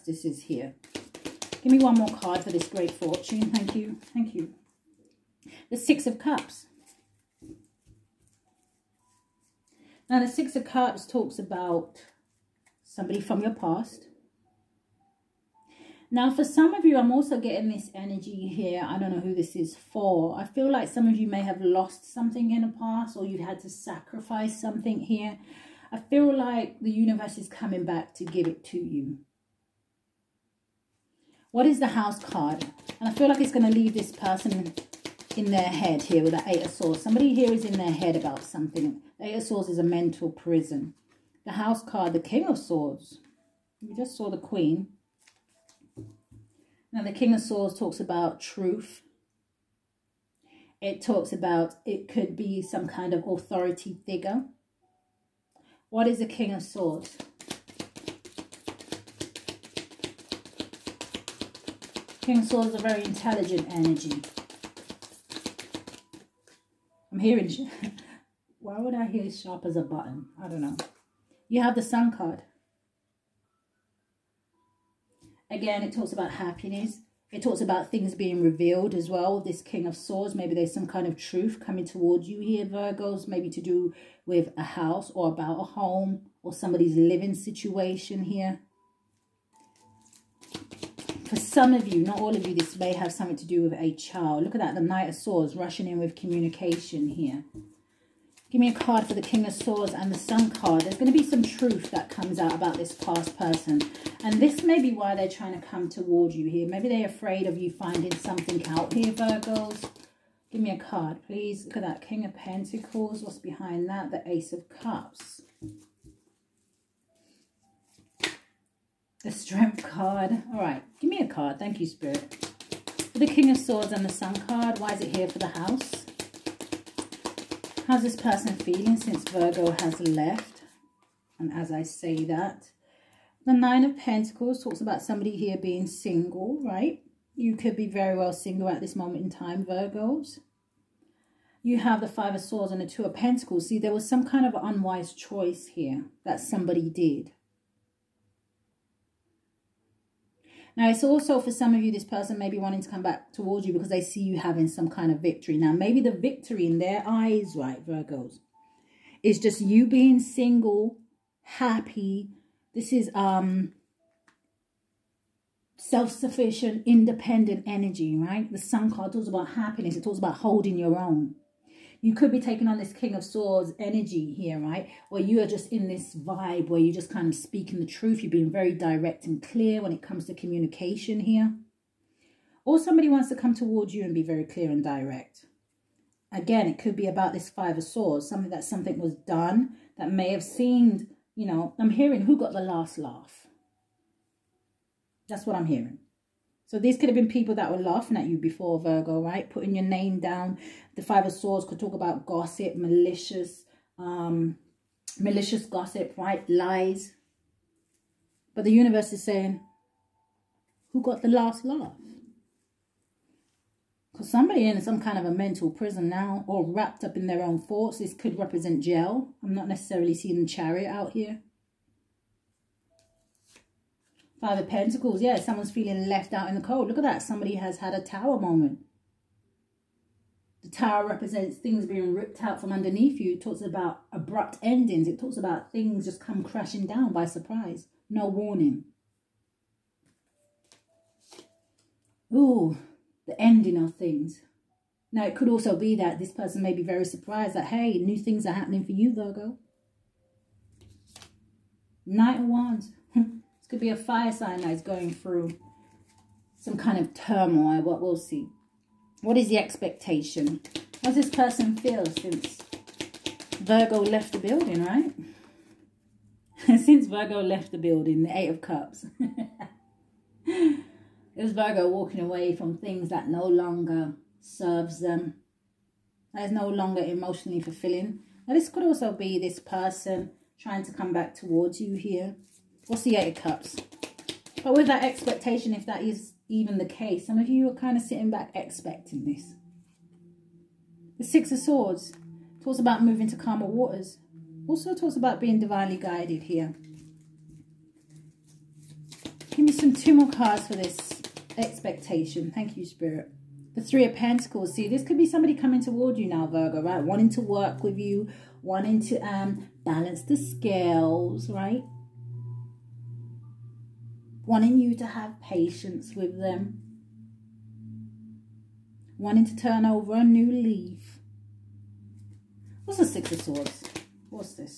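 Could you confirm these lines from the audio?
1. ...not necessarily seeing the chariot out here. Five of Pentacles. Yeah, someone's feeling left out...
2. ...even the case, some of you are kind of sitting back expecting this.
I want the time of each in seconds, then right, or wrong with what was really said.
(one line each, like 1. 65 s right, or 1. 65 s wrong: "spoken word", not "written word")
1. 219 s right
2. 286 s right.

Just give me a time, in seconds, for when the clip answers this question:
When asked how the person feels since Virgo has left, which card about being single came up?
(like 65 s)
133 s.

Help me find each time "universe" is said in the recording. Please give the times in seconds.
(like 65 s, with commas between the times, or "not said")
26 s, 208 s.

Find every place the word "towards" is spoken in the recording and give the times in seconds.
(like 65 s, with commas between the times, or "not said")
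81 s, 105 s, 153 s, 183 s, 281 s, 305 s.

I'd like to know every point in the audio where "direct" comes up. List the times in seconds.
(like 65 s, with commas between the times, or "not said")
178 s, 184 s.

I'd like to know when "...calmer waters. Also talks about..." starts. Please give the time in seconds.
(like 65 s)
293 s.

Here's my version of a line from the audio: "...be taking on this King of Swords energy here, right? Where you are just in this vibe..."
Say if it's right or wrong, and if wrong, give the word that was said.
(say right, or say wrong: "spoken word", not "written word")
right.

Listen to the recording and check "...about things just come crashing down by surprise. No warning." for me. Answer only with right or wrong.
right.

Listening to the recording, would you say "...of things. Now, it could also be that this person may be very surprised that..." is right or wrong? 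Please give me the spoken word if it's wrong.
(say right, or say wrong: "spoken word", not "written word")
right.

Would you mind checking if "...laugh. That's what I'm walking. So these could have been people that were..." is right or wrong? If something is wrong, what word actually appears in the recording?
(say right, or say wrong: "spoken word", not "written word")
wrong: "hearing", not "walking".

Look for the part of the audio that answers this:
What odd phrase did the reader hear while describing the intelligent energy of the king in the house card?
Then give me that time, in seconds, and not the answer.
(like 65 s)
69 s.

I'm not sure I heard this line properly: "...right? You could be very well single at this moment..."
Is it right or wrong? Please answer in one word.
right.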